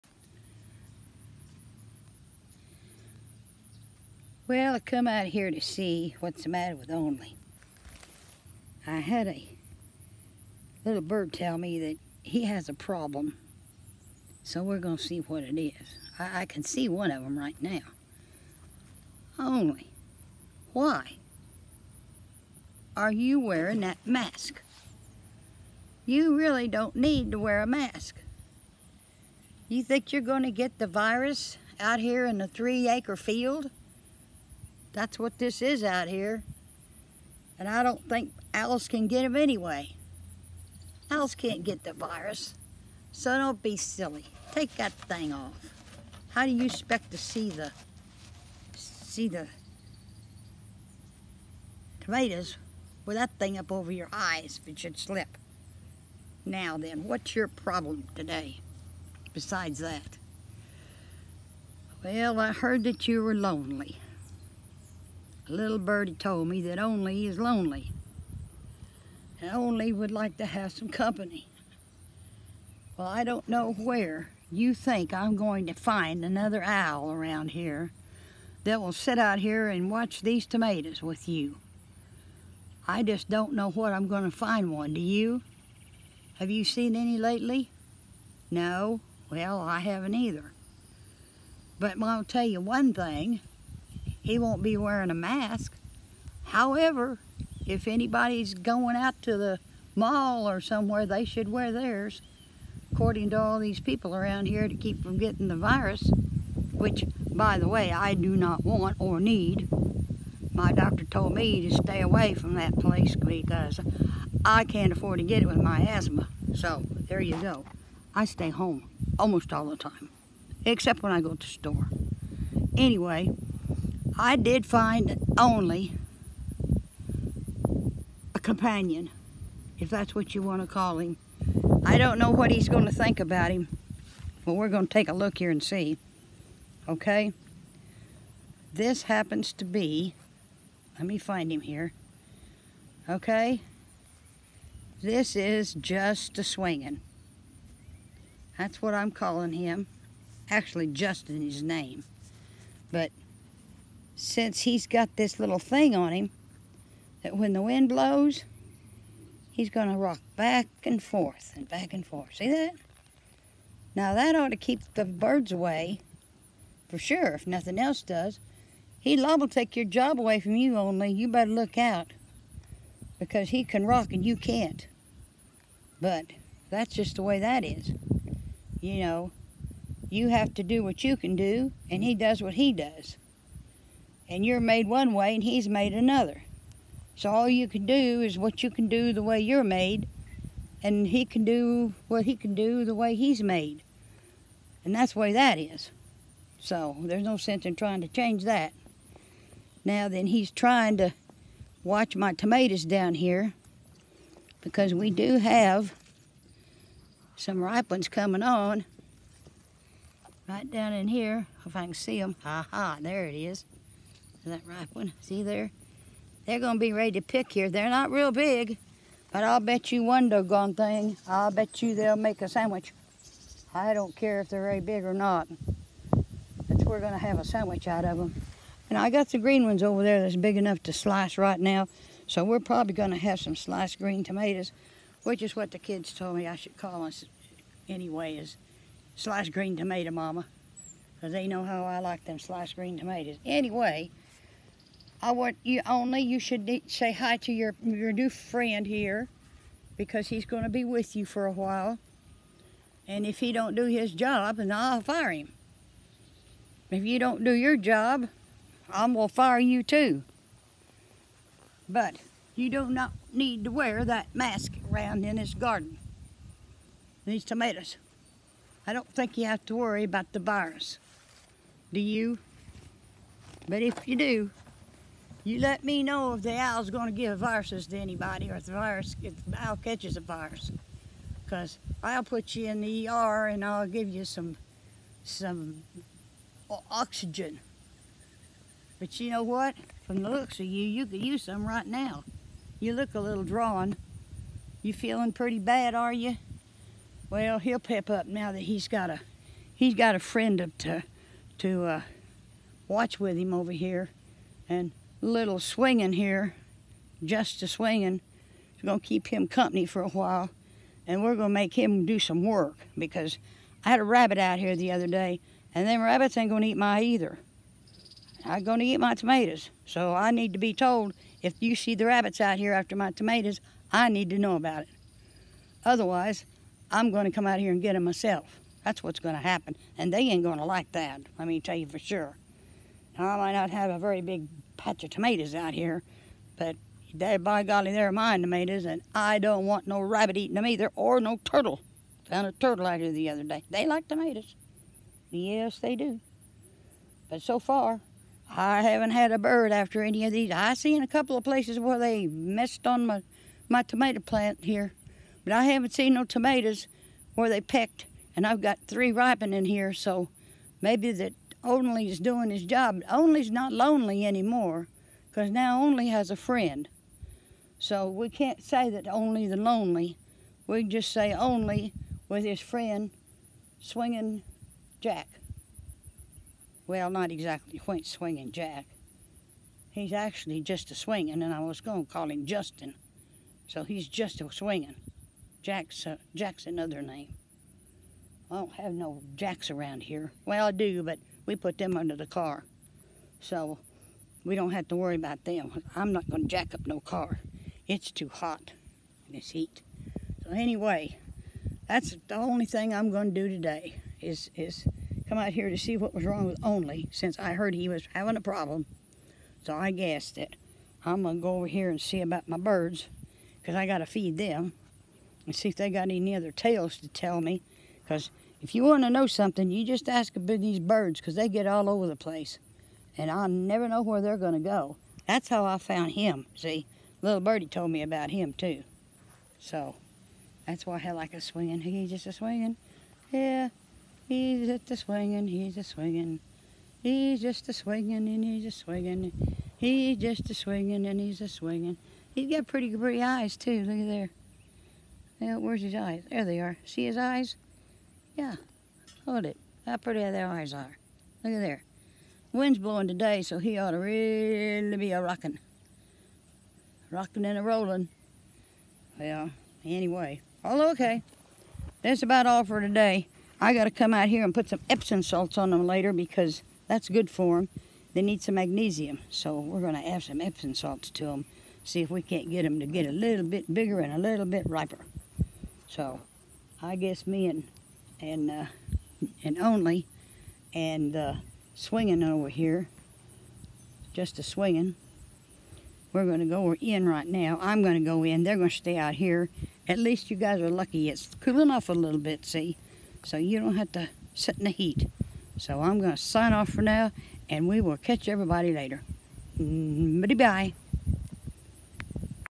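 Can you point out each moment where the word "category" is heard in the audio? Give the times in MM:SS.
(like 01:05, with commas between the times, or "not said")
not said.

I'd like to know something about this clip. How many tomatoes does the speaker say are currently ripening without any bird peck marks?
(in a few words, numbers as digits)
3.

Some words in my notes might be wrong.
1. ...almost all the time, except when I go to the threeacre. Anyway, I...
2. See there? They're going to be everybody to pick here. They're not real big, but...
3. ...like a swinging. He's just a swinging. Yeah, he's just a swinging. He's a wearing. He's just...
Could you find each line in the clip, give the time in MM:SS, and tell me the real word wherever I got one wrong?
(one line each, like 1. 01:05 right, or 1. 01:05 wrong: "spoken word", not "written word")
1. 01:59 wrong: "store", not "threeacre"
2. 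03:35 wrong: "ready", not "everybody"
3. 07:11 wrong: "swinging", not "wearing".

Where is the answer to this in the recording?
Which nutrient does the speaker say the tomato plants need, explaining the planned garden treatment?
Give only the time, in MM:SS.
07:48.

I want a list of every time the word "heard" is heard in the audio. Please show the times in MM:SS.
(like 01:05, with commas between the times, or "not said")
01:02, 06:47.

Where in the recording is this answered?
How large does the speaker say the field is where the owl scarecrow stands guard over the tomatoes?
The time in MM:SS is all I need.
00:32.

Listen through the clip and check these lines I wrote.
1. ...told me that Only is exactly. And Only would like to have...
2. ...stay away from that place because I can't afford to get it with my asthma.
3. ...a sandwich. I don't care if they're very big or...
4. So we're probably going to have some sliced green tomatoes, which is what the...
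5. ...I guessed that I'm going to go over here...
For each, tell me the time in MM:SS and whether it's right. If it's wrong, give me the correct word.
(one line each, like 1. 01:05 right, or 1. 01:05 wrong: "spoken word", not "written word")
1. 01:06 wrong: "lonely", not "exactly"
2. 01:51 right
3. 03:42 right
4. 03:52 right
5. 06:49 right.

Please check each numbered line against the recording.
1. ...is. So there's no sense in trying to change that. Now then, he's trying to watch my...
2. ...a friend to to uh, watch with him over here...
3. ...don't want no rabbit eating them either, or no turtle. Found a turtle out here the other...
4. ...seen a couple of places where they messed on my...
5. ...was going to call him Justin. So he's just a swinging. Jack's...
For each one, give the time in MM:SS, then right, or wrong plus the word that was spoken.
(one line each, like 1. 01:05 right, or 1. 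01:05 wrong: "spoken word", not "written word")
1. 03:15 right
2. 05:00 right
3. 05:39 right
4. 05:50 right
5. 06:21 right.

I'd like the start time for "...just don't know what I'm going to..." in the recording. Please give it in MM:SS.
01:23.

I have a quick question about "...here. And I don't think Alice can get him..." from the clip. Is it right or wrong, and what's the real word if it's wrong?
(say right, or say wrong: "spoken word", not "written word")
right.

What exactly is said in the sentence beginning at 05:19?
So I need to be told if you see the rabbits out here after my tomatoes, I need to know about it.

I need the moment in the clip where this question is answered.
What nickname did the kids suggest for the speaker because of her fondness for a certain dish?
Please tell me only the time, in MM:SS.
03:59.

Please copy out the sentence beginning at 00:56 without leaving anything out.
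Now then, what's your problem today besides that?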